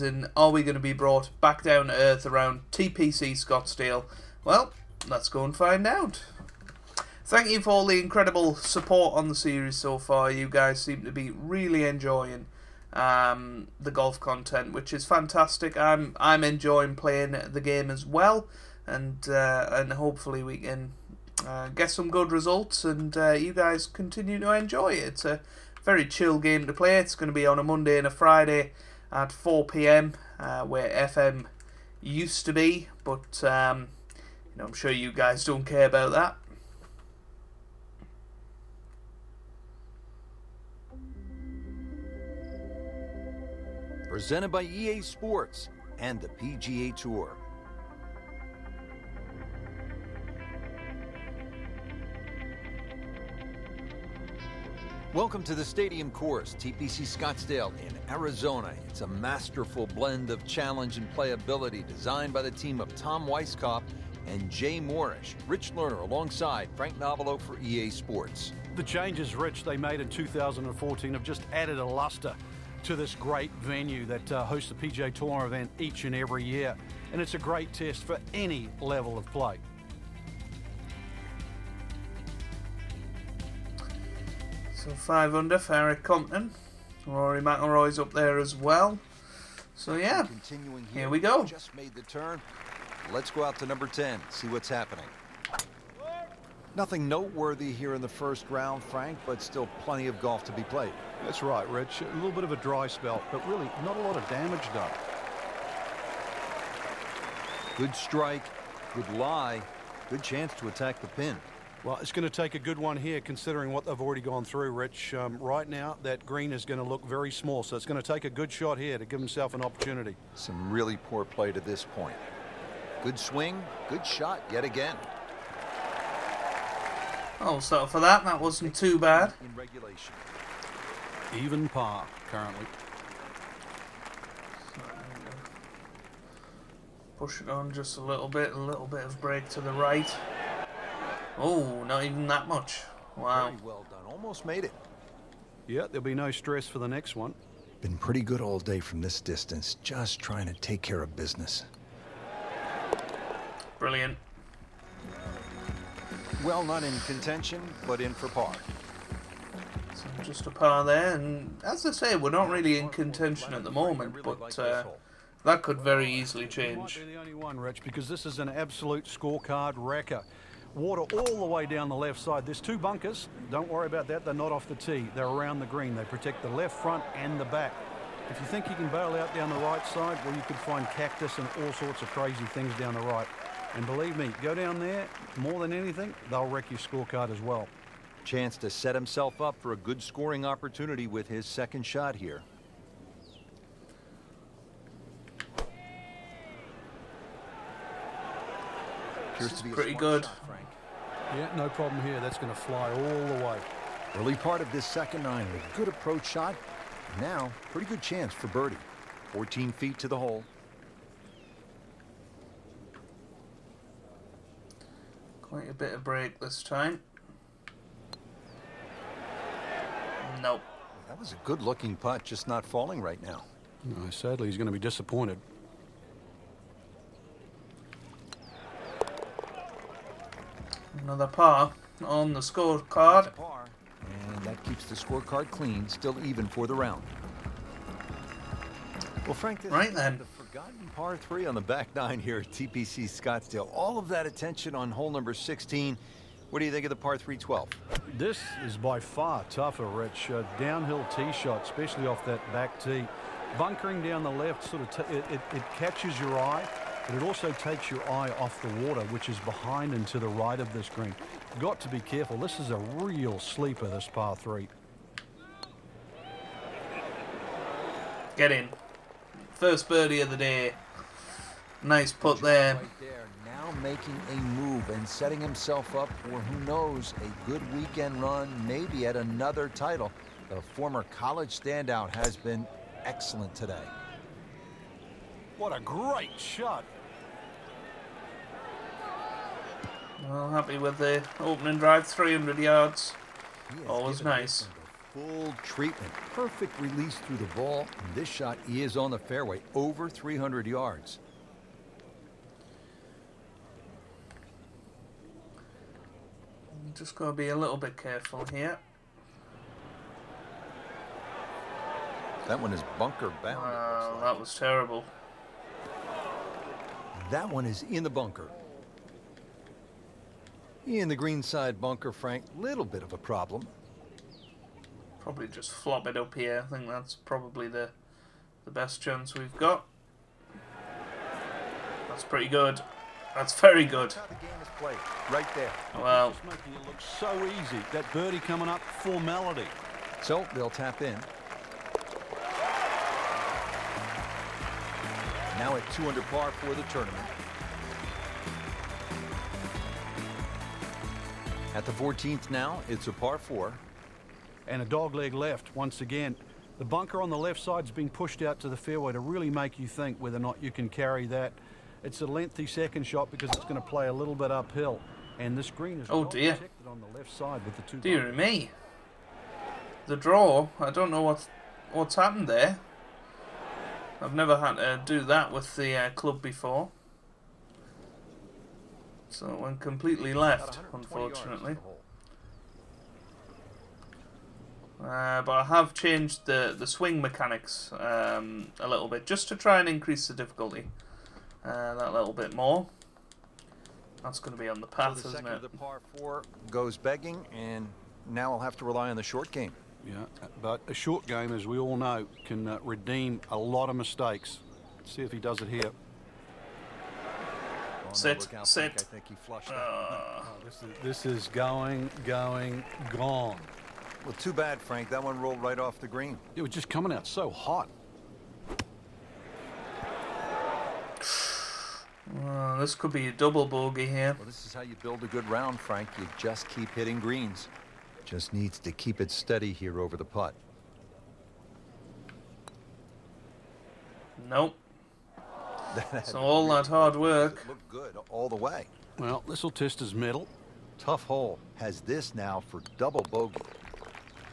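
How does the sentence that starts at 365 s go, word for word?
And this green is oh dear.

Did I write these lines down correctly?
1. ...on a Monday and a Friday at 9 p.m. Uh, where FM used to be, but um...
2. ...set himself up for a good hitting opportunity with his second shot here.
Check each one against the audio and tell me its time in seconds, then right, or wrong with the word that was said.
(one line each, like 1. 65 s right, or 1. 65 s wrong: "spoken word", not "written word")
1. 27 s wrong: "4", not "9"
2. 188 s wrong: "scoring", not "hitting".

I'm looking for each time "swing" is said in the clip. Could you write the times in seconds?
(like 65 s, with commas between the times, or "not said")
123 s, 386 s.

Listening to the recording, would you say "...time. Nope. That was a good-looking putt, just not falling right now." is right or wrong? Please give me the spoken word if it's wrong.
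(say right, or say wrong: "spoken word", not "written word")
right.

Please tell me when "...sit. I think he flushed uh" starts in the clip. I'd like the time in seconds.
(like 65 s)
408 s.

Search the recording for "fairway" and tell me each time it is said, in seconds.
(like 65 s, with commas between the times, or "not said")
299 s, 358 s.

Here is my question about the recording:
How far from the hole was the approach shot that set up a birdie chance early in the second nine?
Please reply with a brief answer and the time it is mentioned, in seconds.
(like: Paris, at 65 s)
14 feet, at 209 s.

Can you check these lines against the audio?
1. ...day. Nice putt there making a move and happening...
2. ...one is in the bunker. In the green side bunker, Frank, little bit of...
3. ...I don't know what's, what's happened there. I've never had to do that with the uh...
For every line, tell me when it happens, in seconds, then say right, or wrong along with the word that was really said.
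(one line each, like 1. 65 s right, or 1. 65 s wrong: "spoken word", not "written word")
1. 270 s wrong: "setting", not "happening"
2. 317 s right
3. 370 s right.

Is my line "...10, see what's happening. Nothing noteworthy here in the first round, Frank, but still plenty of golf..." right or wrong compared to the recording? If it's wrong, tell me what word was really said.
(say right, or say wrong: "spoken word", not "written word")
right.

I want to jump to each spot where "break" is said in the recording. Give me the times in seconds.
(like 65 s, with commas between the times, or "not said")
139 s, 216 s.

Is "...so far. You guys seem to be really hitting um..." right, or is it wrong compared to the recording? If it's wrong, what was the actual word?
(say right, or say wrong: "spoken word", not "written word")
wrong: "enjoying", not "hitting".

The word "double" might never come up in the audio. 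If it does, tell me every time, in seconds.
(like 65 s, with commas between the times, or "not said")
423 s, 442 s.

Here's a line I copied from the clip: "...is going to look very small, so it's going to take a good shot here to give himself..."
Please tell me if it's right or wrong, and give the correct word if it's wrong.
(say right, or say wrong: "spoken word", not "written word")
right.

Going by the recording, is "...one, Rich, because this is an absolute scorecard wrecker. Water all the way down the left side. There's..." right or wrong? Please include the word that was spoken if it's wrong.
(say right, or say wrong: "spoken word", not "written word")
right.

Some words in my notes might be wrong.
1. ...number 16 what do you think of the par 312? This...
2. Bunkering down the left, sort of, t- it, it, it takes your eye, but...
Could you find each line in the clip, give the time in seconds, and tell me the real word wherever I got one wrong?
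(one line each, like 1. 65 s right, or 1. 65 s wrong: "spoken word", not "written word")
1. 245 s right
2. 253 s wrong: "catches", not "takes".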